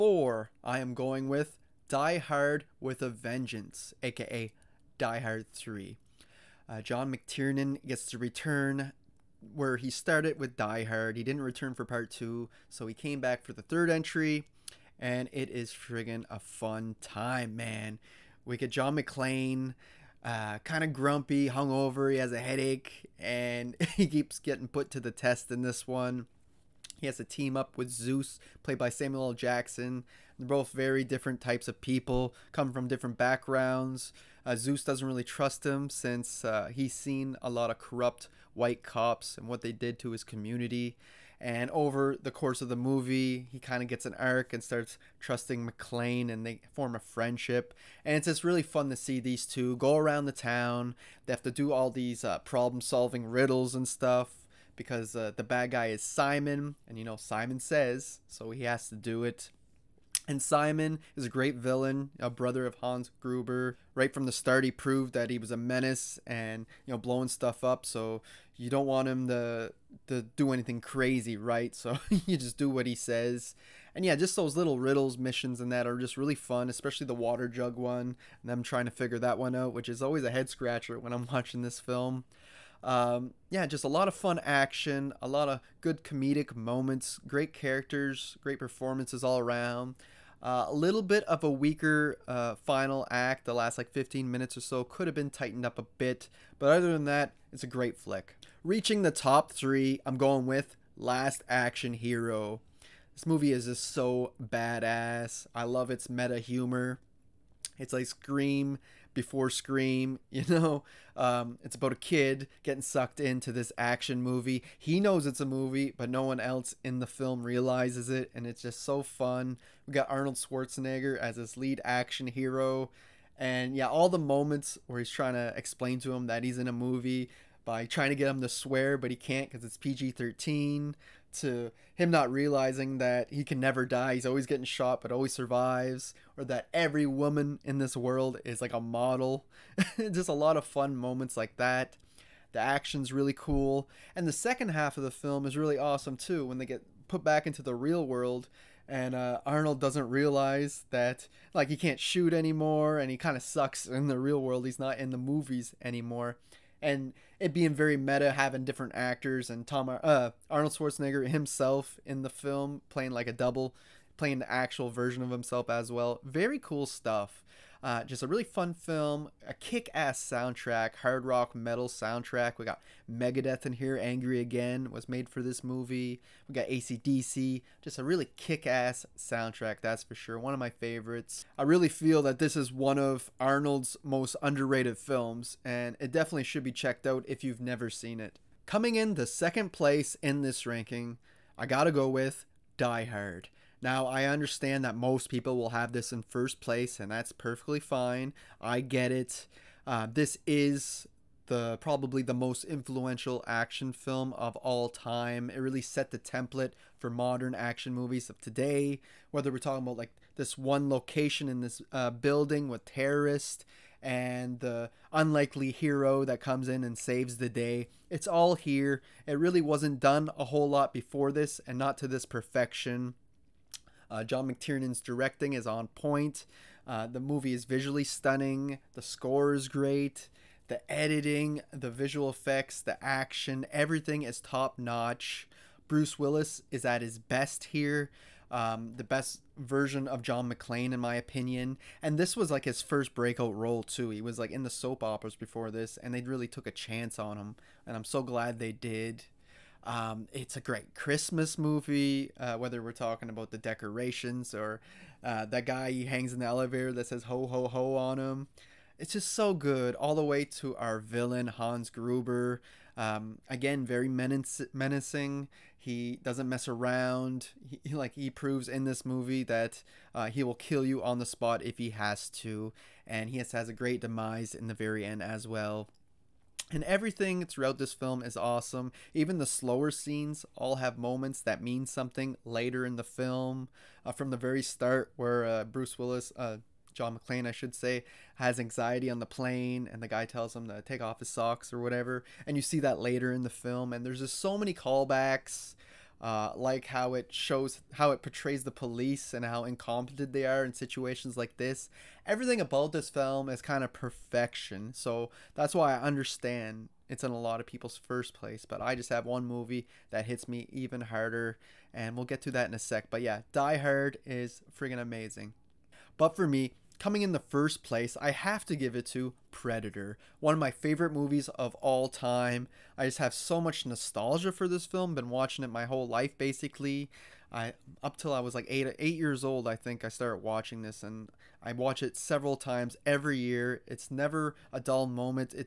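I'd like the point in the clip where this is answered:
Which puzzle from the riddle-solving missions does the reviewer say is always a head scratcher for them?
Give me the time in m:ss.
1:17.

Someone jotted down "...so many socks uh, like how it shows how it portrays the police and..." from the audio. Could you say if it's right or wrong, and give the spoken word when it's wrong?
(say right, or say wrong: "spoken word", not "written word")
wrong: "callbacks", not "socks".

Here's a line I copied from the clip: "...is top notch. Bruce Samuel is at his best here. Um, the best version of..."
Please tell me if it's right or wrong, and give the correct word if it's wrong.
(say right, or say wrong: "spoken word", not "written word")
wrong: "Willis", not "Samuel".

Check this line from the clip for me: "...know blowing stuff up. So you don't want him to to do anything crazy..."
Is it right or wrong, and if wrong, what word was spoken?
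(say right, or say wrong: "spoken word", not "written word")
right.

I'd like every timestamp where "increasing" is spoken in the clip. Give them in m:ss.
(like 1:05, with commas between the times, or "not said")
not said.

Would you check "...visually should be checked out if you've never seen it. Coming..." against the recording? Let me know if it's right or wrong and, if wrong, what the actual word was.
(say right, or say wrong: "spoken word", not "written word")
wrong: "definitely", not "visually".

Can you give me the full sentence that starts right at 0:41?
And over the course of the movie, he kind of gets an arc and starts trusting McClane, and they form a friendship.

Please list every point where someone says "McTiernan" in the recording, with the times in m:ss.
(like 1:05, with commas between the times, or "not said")
0:07, 3:44.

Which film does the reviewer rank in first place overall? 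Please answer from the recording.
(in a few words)
Predator.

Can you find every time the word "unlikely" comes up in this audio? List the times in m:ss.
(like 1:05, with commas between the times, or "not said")
3:35.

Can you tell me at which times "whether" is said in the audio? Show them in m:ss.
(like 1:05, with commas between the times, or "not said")
3:29, 4:12.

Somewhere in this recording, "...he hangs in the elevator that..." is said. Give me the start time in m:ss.
4:15.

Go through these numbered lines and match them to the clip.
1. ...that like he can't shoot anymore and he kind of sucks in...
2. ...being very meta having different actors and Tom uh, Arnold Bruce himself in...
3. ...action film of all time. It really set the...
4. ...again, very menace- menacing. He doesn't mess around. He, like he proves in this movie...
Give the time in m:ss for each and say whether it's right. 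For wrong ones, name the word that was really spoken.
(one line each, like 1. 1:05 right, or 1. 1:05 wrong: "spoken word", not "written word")
1. 2:30 right
2. 2:37 wrong: "Schwarzenegger", not "Bruce"
3. 3:23 right
4. 4:23 right.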